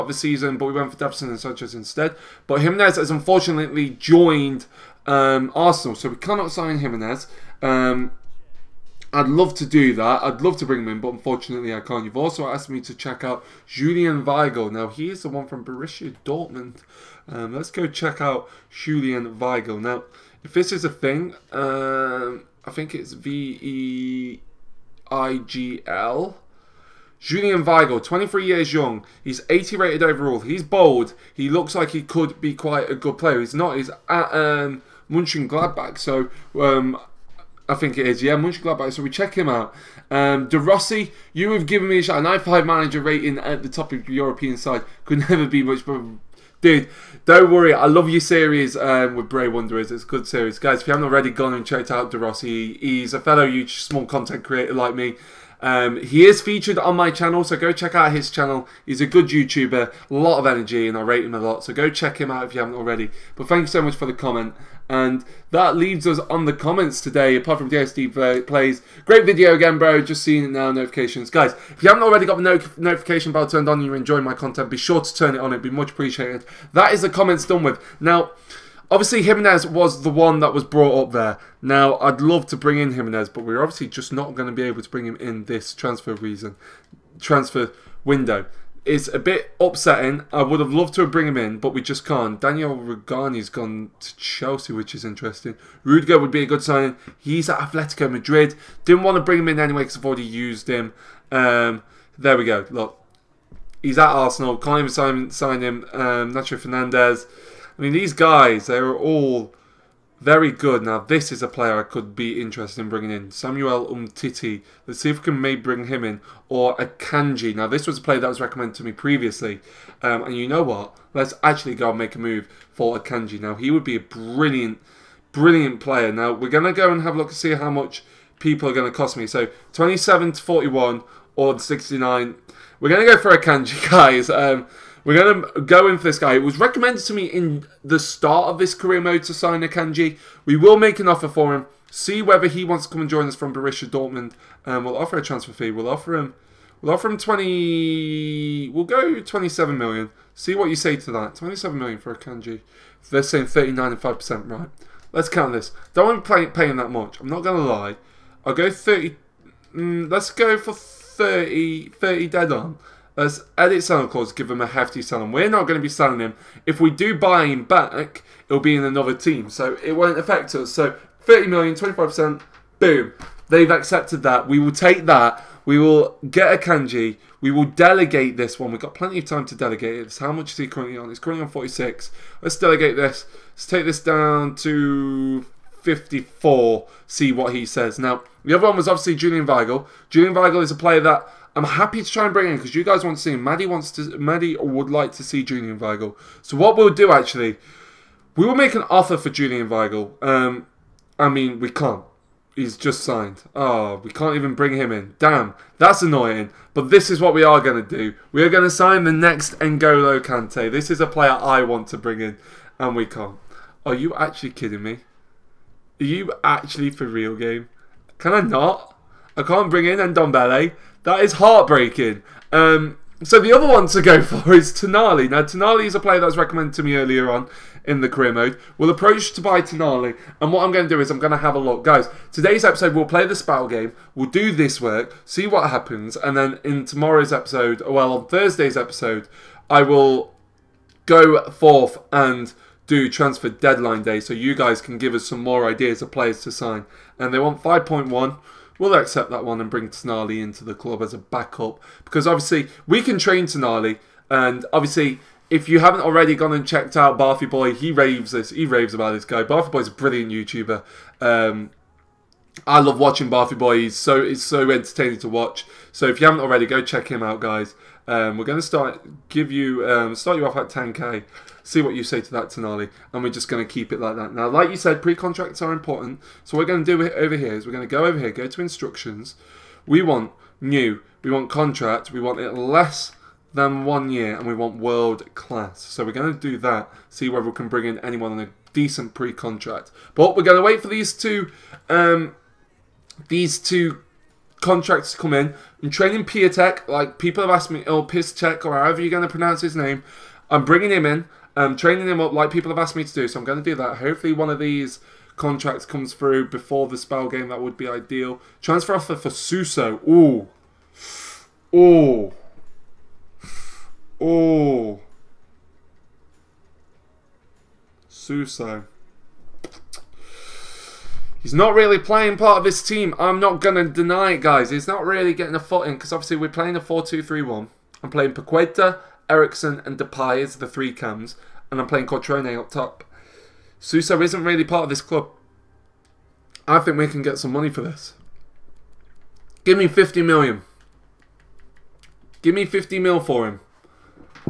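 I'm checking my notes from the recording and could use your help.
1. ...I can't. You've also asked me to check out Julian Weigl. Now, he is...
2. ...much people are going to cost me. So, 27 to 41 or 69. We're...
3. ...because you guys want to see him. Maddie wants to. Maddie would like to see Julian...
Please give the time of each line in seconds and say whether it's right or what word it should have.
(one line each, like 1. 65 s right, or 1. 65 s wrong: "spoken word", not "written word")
1. 11 s right
2. 127 s right
3. 192 s right.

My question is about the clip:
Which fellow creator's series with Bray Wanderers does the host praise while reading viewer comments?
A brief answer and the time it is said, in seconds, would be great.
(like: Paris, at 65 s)
De Rossi, at 40 s.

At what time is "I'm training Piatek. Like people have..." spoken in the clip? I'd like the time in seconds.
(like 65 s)
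295 s.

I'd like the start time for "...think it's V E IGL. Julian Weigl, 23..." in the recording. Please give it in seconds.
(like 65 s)
22 s.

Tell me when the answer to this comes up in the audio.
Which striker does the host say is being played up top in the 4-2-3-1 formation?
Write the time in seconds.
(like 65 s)
332 s.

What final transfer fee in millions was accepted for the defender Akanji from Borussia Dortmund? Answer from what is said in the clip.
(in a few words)
30 million.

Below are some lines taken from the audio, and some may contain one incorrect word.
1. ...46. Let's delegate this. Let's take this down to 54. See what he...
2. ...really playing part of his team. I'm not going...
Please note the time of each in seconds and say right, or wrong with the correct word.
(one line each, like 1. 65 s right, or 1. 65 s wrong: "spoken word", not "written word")
1. 181 s right
2. 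321 s right.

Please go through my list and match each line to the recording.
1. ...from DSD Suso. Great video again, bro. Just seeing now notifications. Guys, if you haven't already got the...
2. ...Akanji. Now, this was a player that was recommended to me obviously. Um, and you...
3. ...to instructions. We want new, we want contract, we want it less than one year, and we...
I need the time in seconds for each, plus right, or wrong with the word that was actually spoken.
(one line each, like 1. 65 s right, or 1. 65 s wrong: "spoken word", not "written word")
1. 67 s wrong: "Plays", not "Suso"
2. 116 s wrong: "previously", not "obviously"
3. 278 s right.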